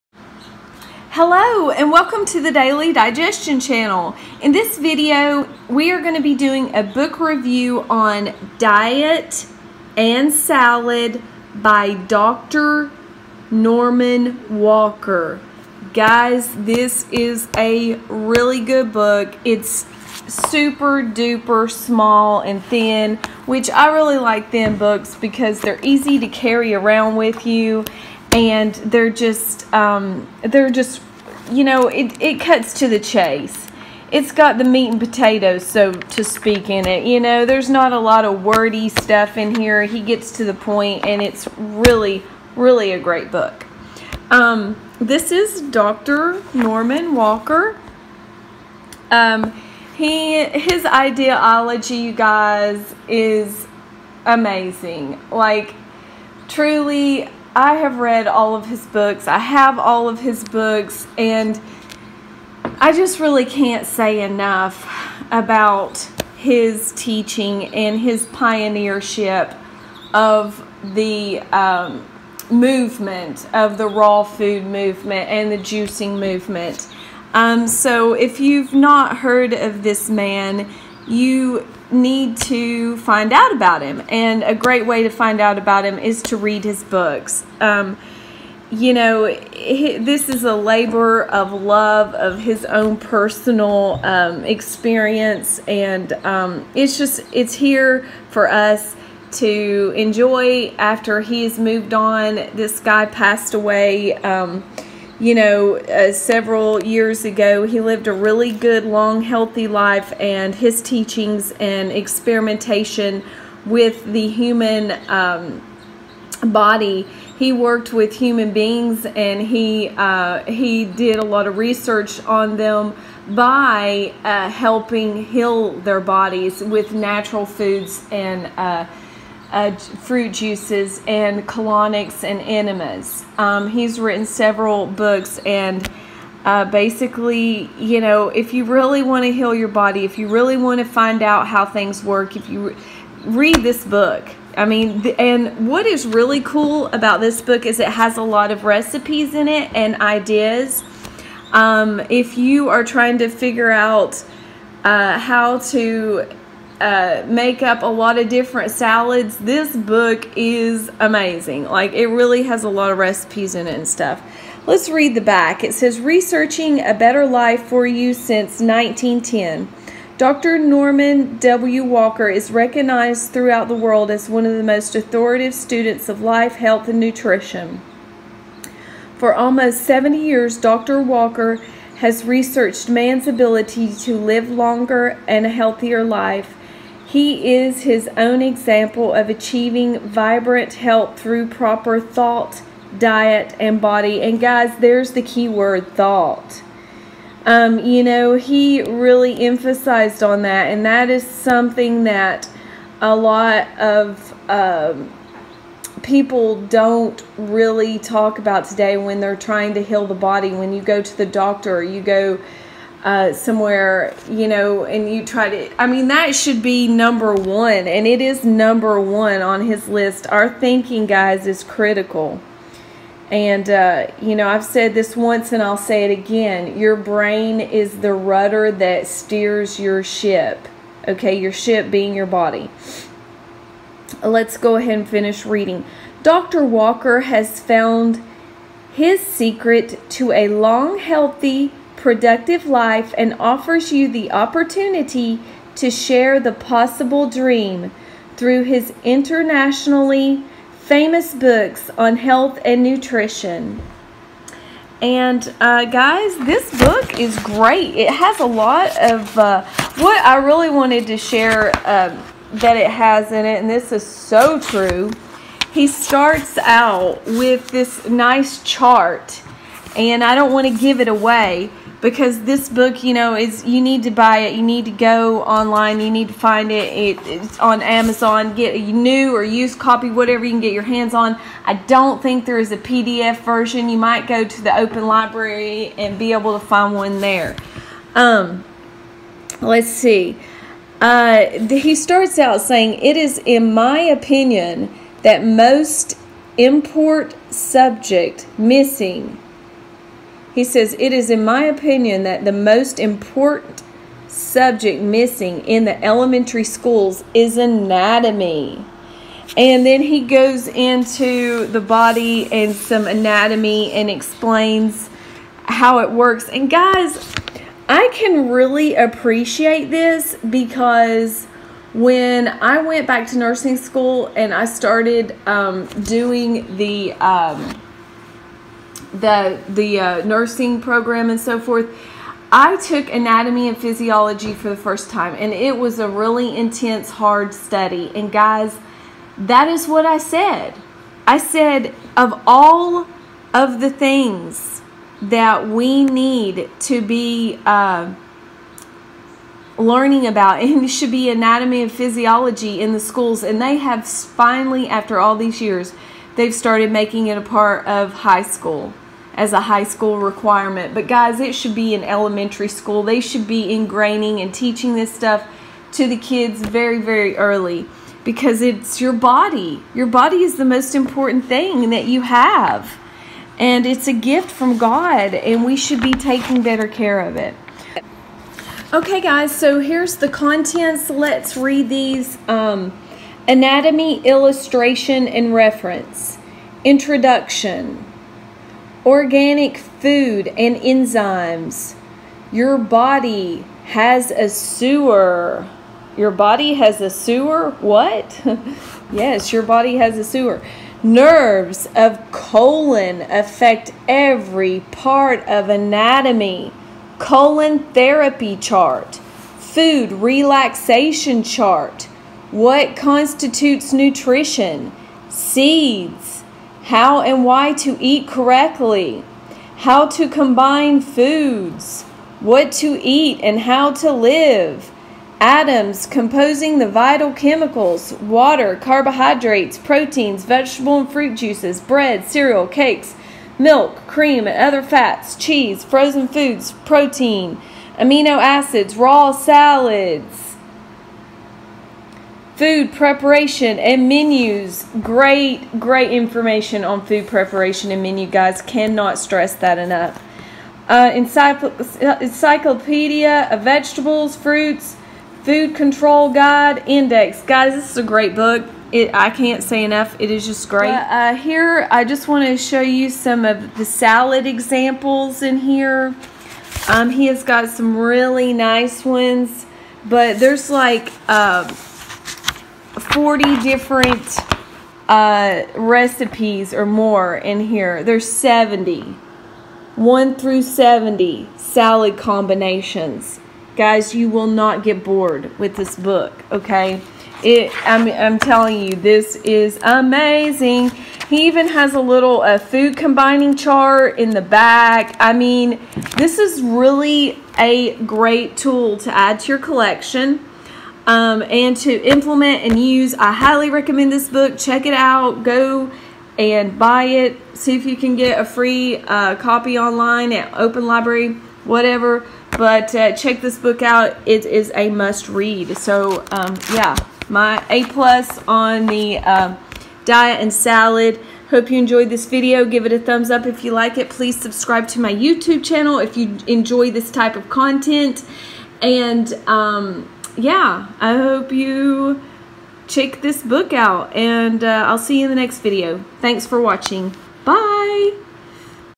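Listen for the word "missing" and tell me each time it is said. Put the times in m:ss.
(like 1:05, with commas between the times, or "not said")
4:58, 5:05.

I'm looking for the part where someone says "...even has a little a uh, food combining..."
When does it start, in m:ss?
8:11.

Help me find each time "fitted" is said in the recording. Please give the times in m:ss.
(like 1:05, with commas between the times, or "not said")
not said.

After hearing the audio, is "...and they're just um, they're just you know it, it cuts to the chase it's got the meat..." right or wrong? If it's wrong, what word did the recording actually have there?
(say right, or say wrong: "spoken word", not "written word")
right.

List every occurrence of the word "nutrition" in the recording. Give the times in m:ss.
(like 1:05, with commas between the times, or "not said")
2:56, 4:12, 6:53.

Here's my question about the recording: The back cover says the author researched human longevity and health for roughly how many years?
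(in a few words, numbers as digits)
70 years.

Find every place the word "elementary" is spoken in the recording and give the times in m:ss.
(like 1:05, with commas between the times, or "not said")
5:06, 6:02.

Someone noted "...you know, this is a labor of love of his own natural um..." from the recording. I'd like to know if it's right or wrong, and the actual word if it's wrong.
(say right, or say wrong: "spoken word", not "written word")
wrong: "personal", not "natural".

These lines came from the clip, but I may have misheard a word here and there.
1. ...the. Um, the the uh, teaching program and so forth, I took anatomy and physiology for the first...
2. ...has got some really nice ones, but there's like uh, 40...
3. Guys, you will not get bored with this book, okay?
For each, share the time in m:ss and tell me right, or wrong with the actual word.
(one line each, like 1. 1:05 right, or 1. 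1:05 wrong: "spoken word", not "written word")
1. 5:26 wrong: "nursing", not "teaching"
2. 7:47 right
3. 8:03 right.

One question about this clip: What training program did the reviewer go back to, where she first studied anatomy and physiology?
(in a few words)
Nursing school.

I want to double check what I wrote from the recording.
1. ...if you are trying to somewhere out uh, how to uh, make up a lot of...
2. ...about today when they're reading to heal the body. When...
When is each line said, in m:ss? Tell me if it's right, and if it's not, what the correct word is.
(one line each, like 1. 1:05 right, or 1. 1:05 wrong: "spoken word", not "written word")
1. 2:32 wrong: "figure", not "somewhere"
2. 3:28 wrong: "trying", not "reading".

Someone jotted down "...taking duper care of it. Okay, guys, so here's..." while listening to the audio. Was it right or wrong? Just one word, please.
wrong.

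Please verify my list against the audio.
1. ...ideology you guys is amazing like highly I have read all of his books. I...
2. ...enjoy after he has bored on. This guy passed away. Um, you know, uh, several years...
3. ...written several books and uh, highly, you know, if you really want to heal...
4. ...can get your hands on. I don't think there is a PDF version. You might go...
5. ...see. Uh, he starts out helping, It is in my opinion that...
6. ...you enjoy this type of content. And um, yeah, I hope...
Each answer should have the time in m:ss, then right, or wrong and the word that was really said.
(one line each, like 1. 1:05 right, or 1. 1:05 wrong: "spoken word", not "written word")
1. 0:50 wrong: "truly", not "highly"
2. 1:39 wrong: "moved", not "bored"
3. 2:13 wrong: "basically", not "highly"
4. 4:40 right
5. 4:49 wrong: "saying", not "helping"
6. 8:46 right.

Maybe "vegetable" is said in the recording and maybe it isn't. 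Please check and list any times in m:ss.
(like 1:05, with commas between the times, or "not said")
7:10, 7:33.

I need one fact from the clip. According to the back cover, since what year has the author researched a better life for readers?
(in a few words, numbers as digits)
1910.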